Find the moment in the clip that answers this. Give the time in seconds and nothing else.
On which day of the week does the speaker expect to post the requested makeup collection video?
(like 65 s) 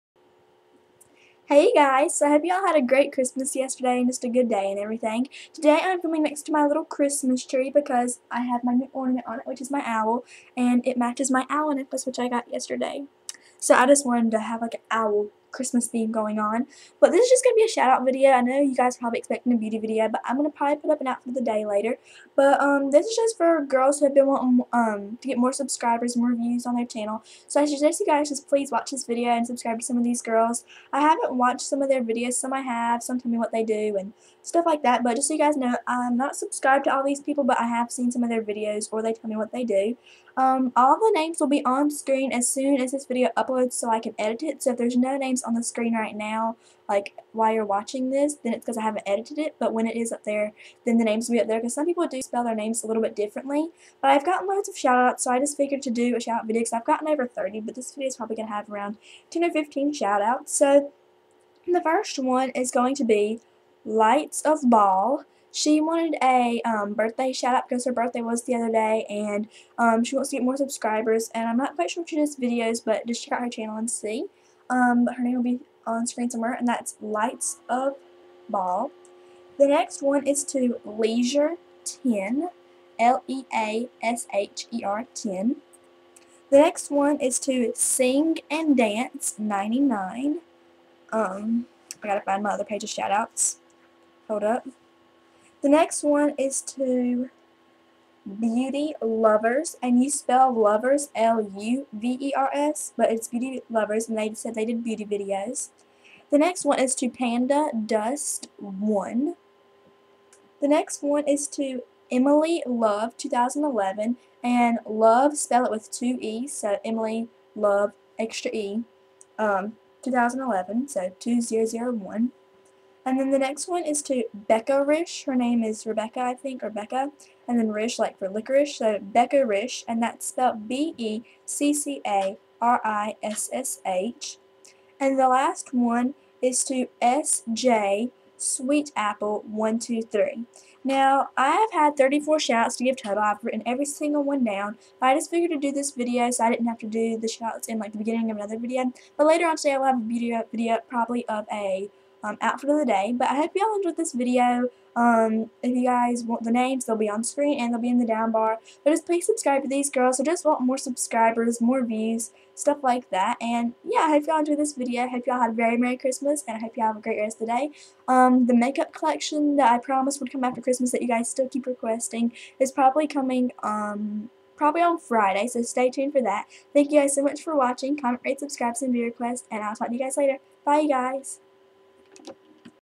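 174 s.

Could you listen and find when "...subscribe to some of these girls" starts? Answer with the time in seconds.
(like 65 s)
29 s.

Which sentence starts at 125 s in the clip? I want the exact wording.
Her name is Rebecca, I think, or Becca.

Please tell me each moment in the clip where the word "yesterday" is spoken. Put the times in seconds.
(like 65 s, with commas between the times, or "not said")
3 s, 12 s.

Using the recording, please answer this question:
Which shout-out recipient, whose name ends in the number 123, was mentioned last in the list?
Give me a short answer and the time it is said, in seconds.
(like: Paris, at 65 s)
SJ Sweet Apple 123, at 137 s.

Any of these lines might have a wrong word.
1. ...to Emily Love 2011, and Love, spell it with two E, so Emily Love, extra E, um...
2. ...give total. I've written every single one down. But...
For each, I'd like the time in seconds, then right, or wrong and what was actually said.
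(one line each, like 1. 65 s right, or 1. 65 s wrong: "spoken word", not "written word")
1. 111 s right
2. 142 s right.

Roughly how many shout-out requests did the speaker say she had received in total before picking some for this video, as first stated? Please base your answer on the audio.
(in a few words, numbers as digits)
Over 30.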